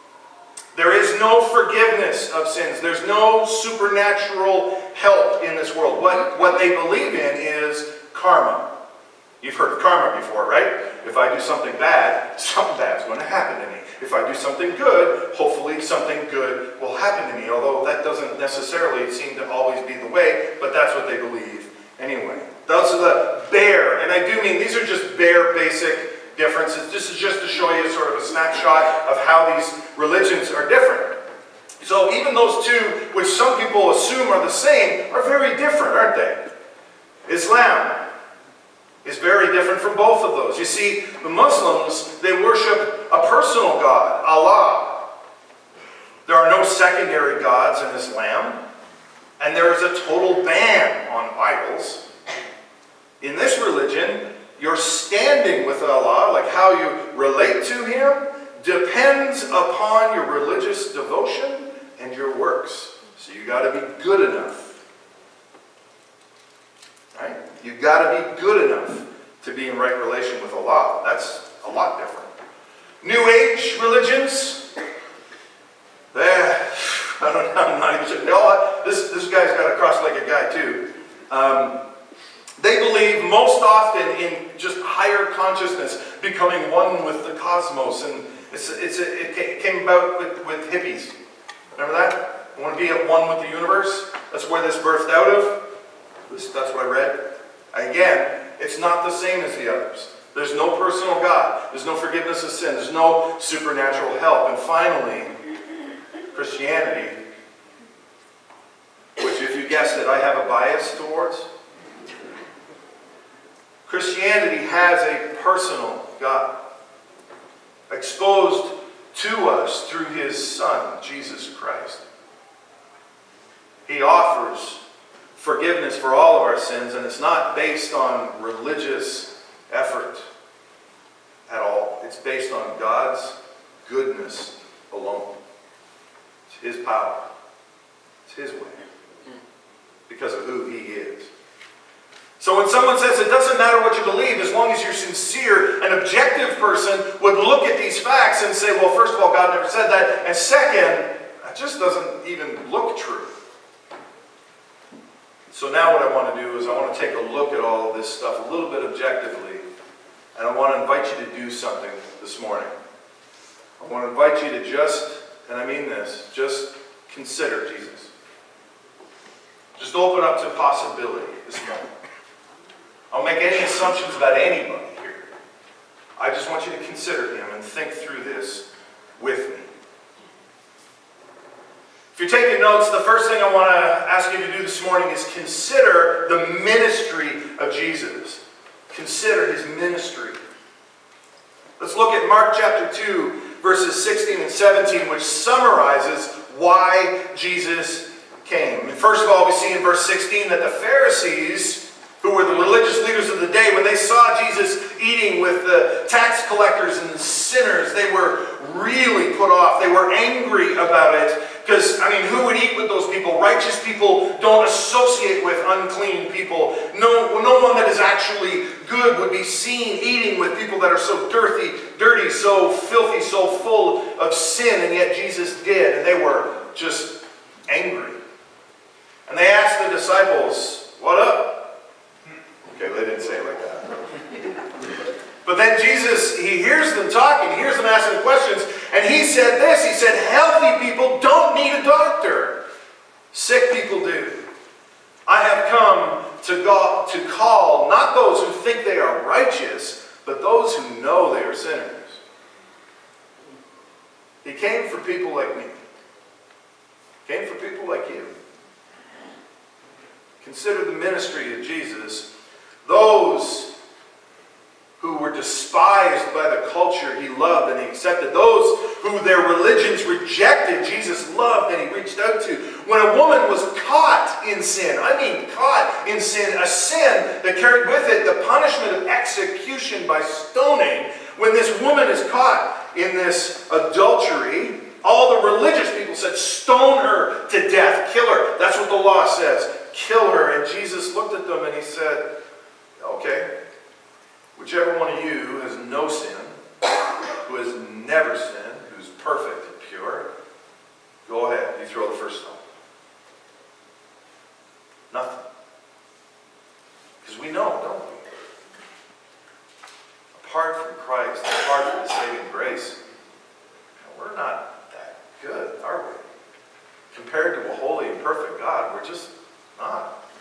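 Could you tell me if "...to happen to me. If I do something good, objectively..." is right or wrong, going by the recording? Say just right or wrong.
wrong.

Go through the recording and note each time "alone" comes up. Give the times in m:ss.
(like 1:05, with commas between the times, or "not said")
2:14.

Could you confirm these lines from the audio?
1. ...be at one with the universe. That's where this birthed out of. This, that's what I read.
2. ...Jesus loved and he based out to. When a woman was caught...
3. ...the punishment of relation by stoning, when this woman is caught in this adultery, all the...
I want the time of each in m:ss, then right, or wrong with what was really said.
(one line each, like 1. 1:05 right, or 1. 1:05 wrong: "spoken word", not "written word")
1. 1:32 right
2. 4:30 wrong: "reached", not "based"
3. 4:38 wrong: "execution", not "relation".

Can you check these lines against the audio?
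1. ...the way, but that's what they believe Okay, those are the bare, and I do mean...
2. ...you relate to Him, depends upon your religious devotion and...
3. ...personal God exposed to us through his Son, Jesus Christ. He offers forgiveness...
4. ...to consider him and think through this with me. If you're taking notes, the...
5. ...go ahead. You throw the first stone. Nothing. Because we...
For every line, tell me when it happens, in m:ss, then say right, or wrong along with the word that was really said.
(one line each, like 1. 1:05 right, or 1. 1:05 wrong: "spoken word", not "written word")
1. 0:19 wrong: "Anyway", not "Okay"
2. 0:56 right
3. 1:55 right
4. 2:56 right
5. 5:01 right.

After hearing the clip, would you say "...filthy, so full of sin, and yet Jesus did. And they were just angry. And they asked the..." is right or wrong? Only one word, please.
right.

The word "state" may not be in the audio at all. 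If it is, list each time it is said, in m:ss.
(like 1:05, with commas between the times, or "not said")
not said.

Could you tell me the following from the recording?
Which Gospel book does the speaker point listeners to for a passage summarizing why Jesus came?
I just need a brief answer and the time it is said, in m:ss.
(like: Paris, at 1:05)
Mark, at 3:12.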